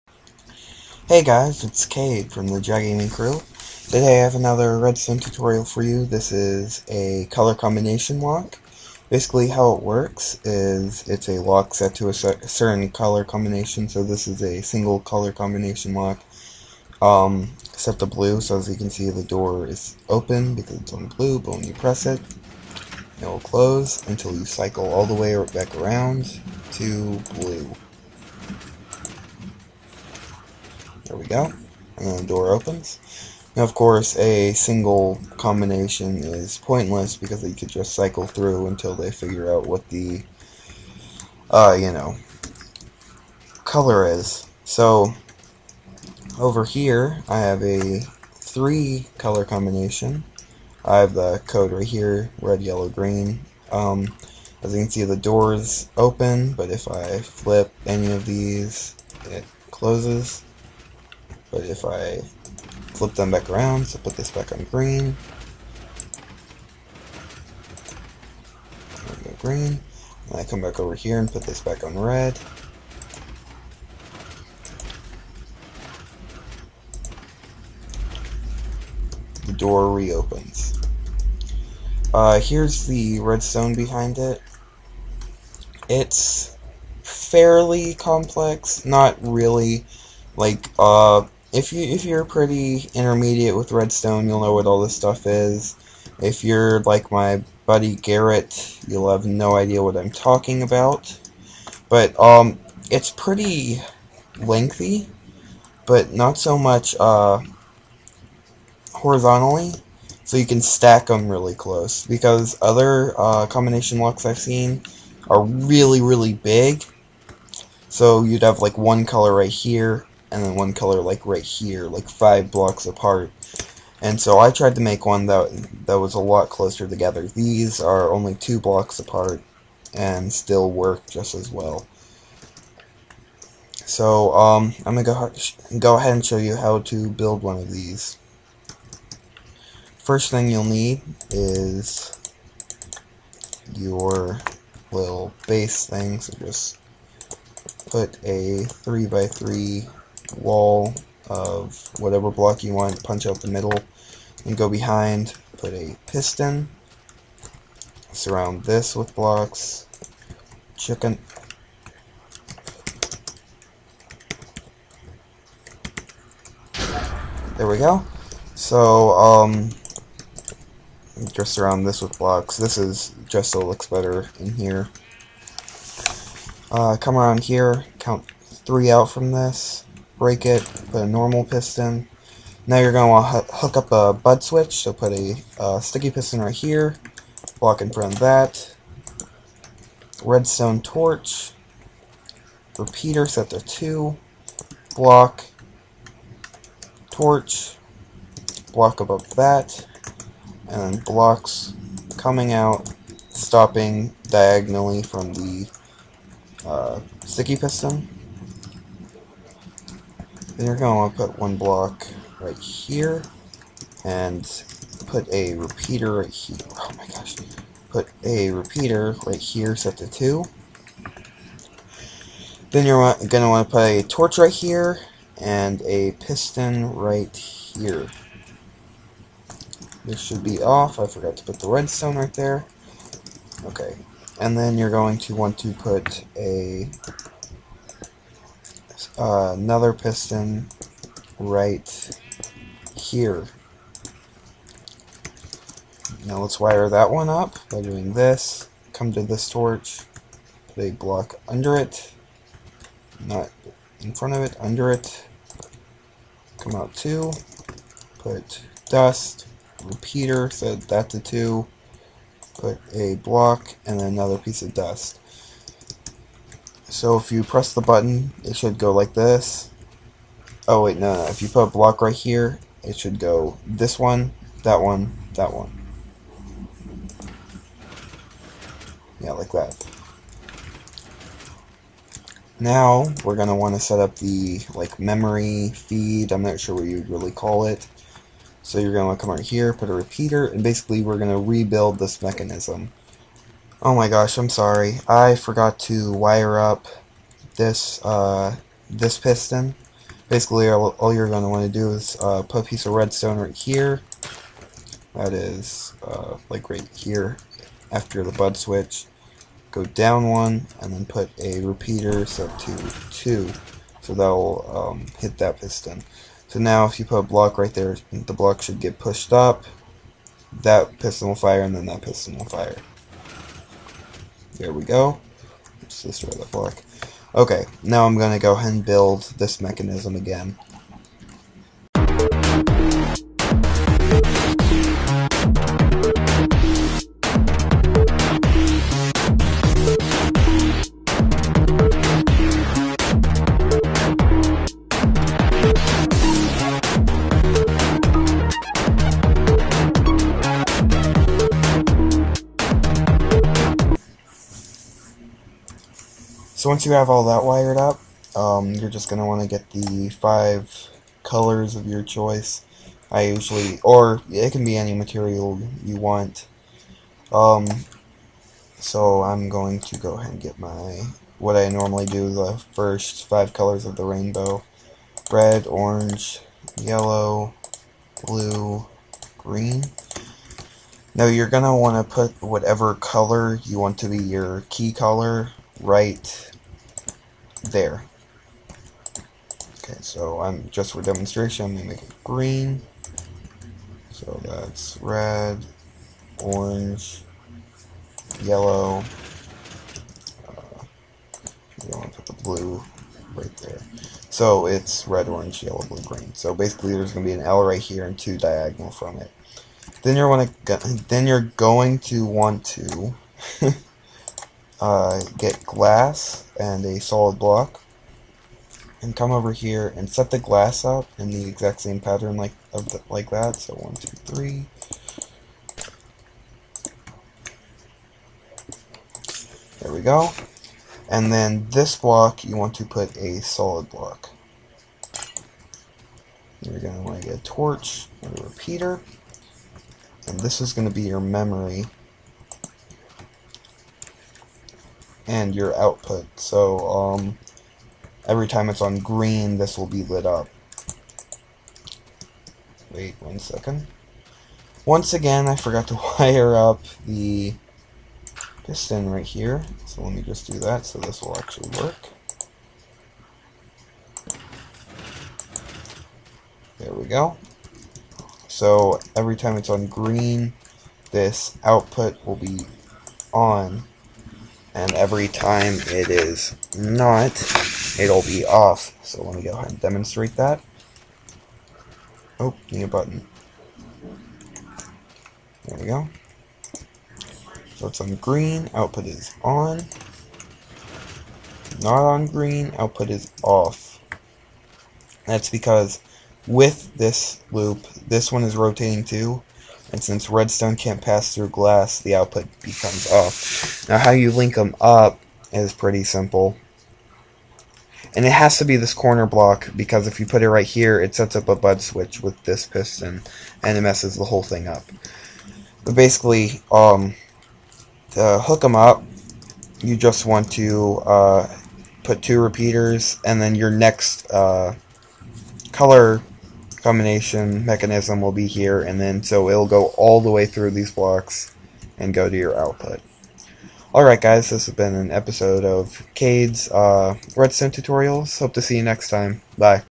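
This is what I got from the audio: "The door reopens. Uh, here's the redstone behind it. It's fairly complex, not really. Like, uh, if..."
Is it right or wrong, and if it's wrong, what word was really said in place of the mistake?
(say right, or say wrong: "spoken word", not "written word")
right.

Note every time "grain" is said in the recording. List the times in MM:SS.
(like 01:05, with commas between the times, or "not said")
not said.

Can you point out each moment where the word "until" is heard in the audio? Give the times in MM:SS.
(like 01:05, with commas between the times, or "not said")
00:24, 00:38.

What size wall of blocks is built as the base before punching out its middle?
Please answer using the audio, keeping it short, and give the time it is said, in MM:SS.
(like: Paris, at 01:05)
3 by 3, at 02:28.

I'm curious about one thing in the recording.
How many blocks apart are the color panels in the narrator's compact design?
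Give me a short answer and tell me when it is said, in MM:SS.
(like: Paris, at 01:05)
2, at 02:08.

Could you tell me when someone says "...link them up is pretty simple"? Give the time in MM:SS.
08:24.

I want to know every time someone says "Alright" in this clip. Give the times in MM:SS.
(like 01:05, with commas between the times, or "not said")
08:53.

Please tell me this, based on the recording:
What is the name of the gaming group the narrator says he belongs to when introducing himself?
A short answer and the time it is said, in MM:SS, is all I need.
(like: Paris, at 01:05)
JaGaming Crew, at 00:02.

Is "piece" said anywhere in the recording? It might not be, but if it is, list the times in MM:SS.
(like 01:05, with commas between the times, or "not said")
04:24, 05:02.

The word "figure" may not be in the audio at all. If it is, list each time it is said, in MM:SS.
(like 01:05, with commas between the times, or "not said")
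00:39.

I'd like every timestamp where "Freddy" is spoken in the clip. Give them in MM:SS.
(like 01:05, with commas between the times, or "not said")
not said.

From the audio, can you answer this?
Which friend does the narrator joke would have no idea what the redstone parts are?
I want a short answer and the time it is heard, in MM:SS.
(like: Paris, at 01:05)
Garrett, at 01:37.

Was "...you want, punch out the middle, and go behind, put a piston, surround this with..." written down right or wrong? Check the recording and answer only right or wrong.
right.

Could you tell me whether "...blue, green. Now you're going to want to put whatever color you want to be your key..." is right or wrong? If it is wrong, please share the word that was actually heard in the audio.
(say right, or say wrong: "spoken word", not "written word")
right.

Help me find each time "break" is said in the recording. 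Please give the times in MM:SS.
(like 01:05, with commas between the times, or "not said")
03:00.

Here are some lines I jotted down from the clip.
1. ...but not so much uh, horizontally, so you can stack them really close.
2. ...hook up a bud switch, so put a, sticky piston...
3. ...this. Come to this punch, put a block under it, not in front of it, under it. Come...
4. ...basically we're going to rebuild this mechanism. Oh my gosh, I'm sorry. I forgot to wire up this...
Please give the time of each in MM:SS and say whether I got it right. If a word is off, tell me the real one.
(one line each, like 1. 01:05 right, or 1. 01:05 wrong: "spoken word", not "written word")
1. 01:45 right
2. 03:03 right
3. 04:08 wrong: "torch", not "punch"
4. 04:50 right.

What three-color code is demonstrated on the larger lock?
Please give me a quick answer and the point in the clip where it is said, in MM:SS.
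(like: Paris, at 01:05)
Red, yellow, green, at 00:52.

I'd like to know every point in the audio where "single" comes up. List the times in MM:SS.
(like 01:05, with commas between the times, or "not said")
00:14, 00:34.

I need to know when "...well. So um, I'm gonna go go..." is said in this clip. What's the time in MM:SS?
02:11.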